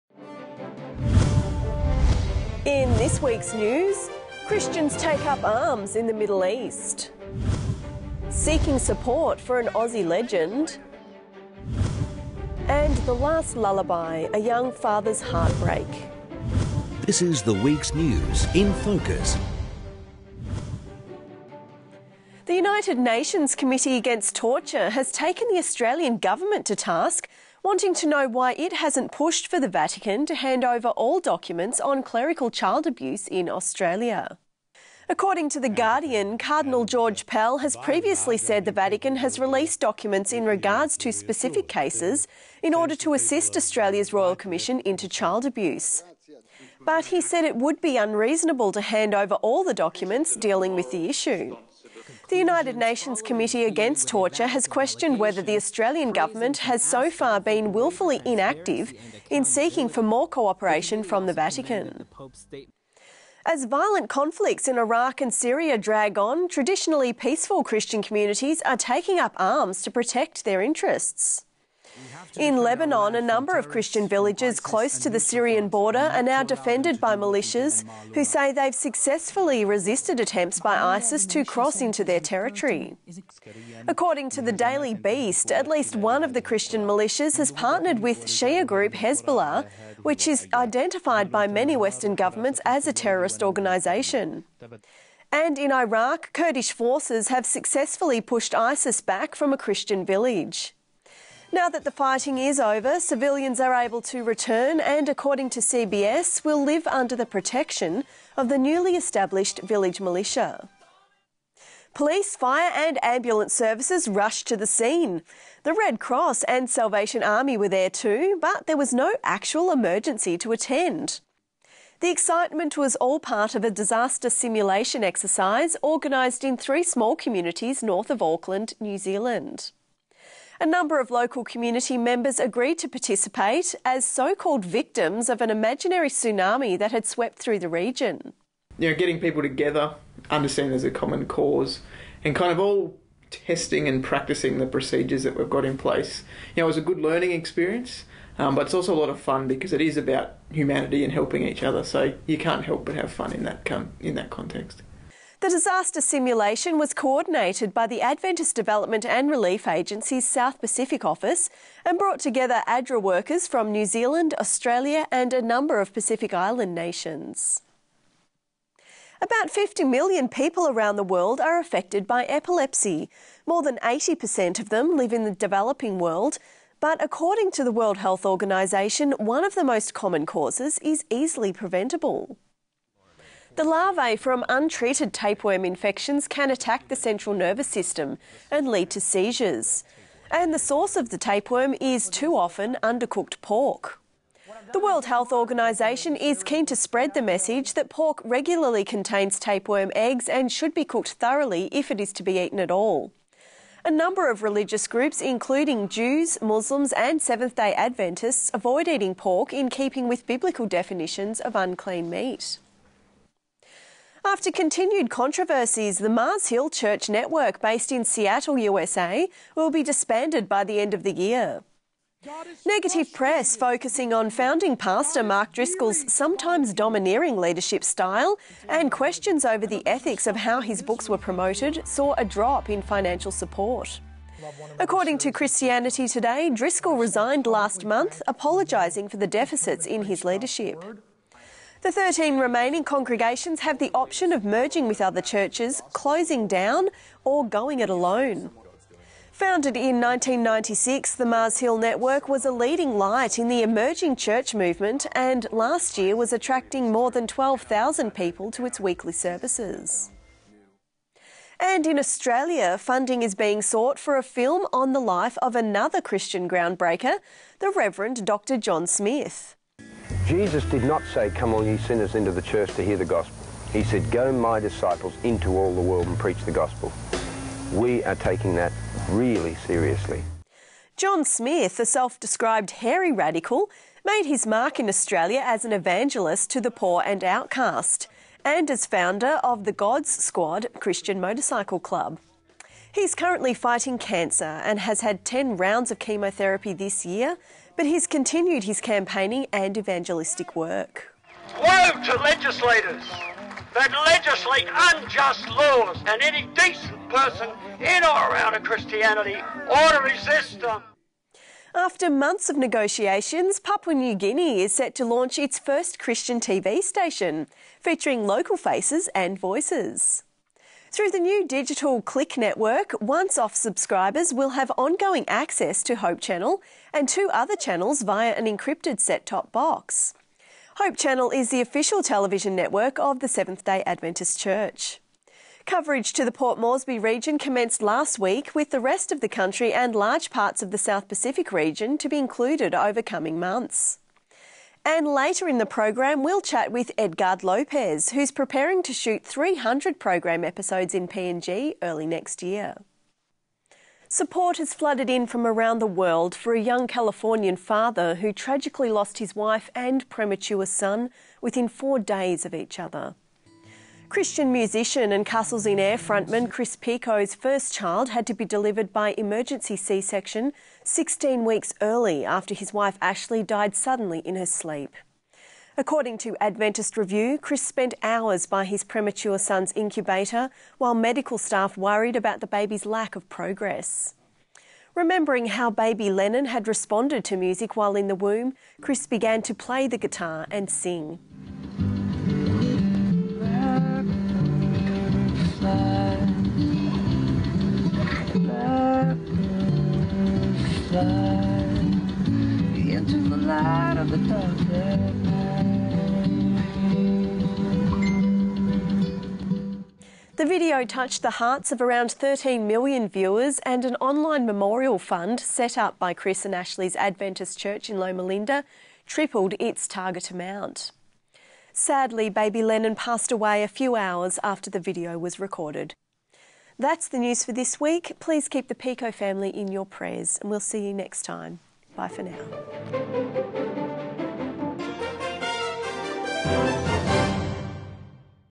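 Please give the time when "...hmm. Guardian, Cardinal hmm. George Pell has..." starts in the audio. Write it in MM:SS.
00:35.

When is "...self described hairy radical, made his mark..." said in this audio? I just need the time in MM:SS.
04:41.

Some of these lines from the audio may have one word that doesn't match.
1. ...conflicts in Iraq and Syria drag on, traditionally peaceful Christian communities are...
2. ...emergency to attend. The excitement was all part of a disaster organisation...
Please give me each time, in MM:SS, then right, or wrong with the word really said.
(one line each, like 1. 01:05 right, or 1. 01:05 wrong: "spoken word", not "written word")
1. 01:04 right
2. 01:59 wrong: "simulation", not "organisation".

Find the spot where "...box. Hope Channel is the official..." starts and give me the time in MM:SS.
05:29.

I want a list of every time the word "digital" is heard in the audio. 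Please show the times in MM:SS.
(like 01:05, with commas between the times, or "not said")
05:21.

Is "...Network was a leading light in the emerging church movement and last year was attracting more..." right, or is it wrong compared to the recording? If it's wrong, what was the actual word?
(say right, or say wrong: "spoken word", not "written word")
right.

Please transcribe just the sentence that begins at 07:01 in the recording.
Sadly, baby Lennon passed away a few hours after the video was recorded.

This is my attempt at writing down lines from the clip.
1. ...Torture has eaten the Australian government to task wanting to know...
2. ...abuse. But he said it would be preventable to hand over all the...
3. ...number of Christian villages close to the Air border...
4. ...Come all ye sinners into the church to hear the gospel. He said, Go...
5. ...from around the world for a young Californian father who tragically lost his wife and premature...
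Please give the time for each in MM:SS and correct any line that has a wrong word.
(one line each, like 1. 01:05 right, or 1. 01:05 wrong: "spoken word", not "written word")
1. 00:24 wrong: "taken", not "eaten"
2. 00:45 wrong: "unreasonable", not "preventable"
3. 01:13 wrong: "Syrian", not "Air"
4. 04:31 right
5. 05:55 right.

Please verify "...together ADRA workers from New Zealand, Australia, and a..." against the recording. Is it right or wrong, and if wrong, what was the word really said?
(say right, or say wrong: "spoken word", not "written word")
right.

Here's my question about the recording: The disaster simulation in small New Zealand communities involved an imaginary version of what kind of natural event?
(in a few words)
Tsunami.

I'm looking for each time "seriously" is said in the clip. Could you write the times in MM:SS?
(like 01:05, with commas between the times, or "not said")
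04:39.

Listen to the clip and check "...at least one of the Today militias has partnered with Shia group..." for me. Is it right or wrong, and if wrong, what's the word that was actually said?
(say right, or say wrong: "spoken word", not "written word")
wrong: "Christian", not "Today".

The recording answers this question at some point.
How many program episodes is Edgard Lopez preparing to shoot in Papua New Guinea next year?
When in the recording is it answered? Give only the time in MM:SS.
05:49.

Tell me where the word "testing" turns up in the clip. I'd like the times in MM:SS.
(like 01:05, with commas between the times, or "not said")
02:23.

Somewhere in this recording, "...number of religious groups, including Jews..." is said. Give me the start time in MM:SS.
03:23.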